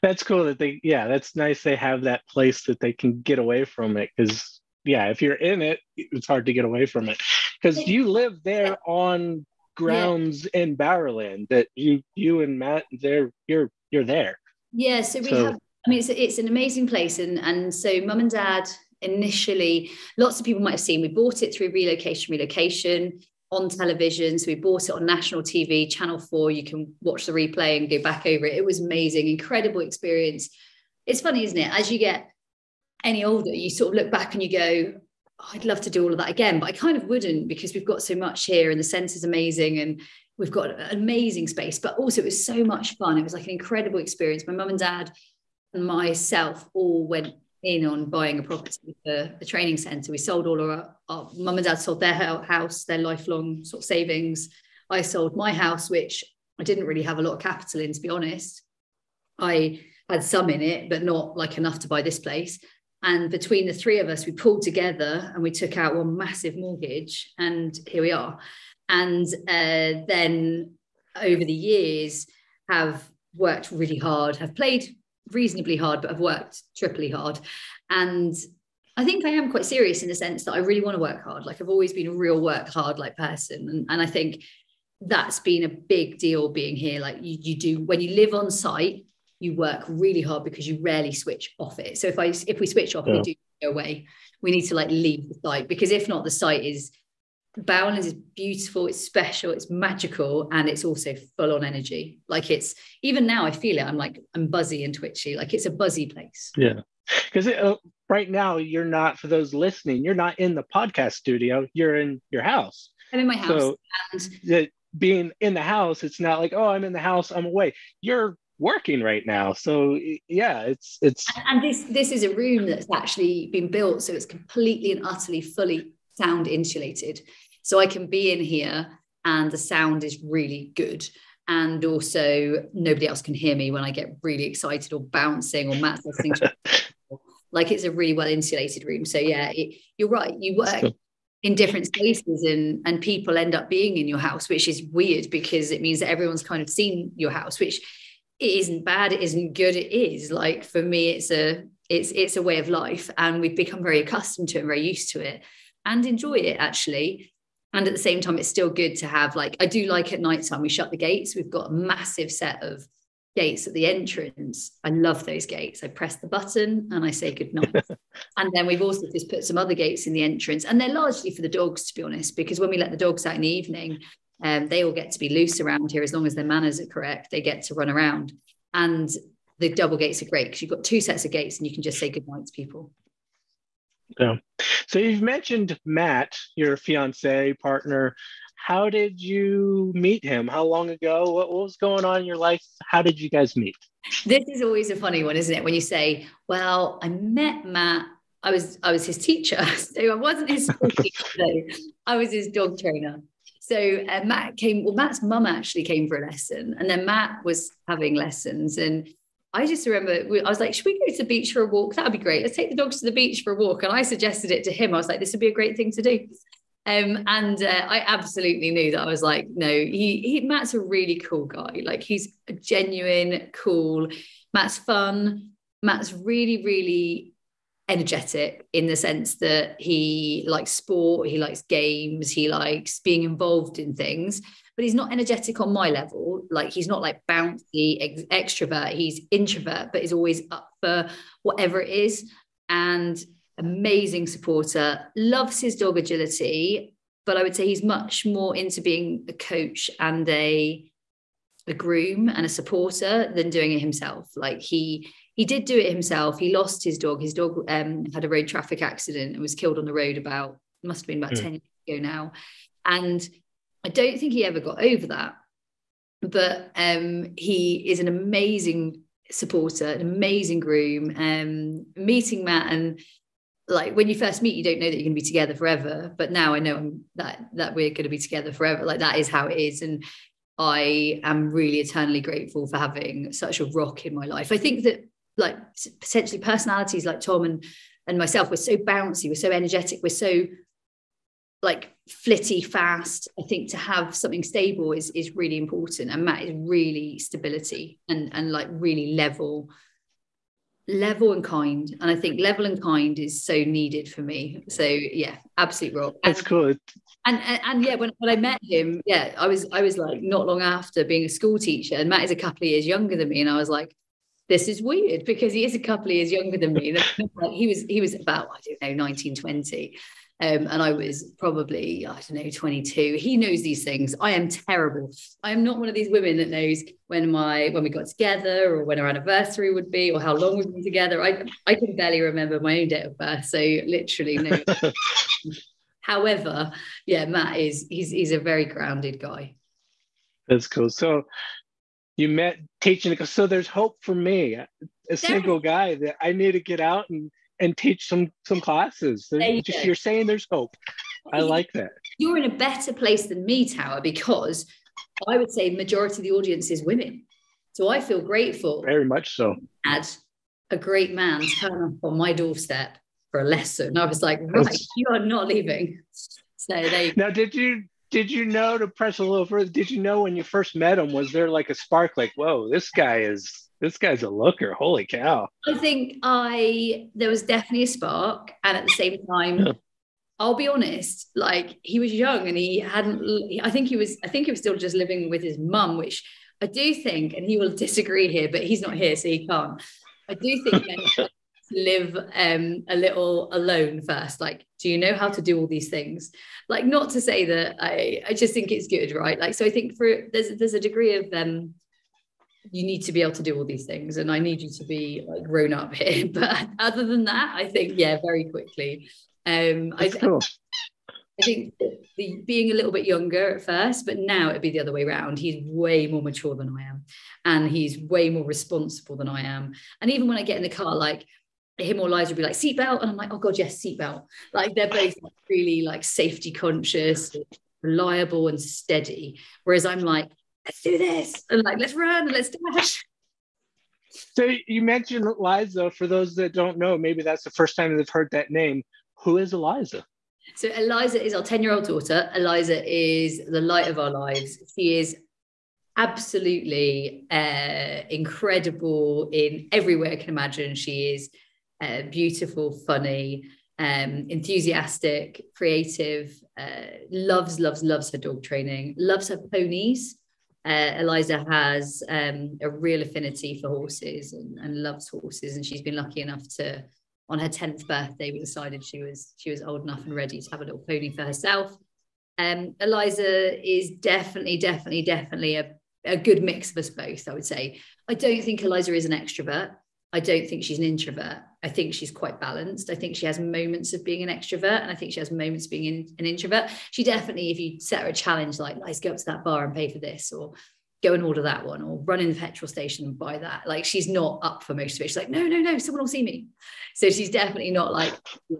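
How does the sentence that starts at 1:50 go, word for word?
You're not in the podcast studio.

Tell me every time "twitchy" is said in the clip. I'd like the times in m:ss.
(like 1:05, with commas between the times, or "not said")
1:44.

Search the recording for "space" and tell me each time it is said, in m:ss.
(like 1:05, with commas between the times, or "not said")
0:41, 2:21.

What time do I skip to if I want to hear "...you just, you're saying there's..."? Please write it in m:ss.
5:49.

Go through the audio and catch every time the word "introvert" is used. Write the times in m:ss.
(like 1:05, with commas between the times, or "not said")
3:59, 8:00, 8:06.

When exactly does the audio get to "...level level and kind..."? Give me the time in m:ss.
4:59.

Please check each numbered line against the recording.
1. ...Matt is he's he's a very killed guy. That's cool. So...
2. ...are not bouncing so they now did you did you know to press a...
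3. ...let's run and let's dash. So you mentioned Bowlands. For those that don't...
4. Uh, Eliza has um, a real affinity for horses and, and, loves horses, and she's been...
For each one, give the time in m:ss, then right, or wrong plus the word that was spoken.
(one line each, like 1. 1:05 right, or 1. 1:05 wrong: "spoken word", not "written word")
1. 5:37 wrong: "grounded", not "killed"
2. 6:05 wrong: "leaving", not "bouncing"
3. 7:11 wrong: "Eliza", not "Bowlands"
4. 7:40 right.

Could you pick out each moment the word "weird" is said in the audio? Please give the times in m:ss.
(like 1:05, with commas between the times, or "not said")
2:24, 5:14.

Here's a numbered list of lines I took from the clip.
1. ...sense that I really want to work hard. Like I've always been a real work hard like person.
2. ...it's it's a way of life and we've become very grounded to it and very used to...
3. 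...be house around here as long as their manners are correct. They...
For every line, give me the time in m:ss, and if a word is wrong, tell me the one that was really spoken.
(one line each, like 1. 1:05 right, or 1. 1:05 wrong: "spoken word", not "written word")
1. 1:20 right
2. 2:31 wrong: "accustomed", not "grounded"
3. 2:55 wrong: "loose", not "house".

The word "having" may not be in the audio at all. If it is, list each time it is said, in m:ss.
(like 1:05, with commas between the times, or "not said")
3:27, 4:42.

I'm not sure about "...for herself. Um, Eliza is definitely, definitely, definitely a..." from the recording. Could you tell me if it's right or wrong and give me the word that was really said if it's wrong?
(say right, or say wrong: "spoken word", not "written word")
right.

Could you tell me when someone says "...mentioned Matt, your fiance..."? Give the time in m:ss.
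3:05.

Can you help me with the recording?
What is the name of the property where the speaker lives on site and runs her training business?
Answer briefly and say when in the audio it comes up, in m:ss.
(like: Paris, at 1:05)
Bowlands, at 1:37.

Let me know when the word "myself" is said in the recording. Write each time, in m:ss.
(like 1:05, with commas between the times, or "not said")
0:45, 4:48.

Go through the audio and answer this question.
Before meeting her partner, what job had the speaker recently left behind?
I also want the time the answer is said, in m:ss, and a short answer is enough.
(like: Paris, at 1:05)
School teacher, at 5:11.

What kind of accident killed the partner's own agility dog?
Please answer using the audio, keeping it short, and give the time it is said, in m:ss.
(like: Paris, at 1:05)
Road traffic accident, at 4:18.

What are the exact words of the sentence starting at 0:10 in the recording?
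in Bowerland that you you and Matt there you're you're there.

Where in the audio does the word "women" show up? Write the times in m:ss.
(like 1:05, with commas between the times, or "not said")
5:26, 5:56.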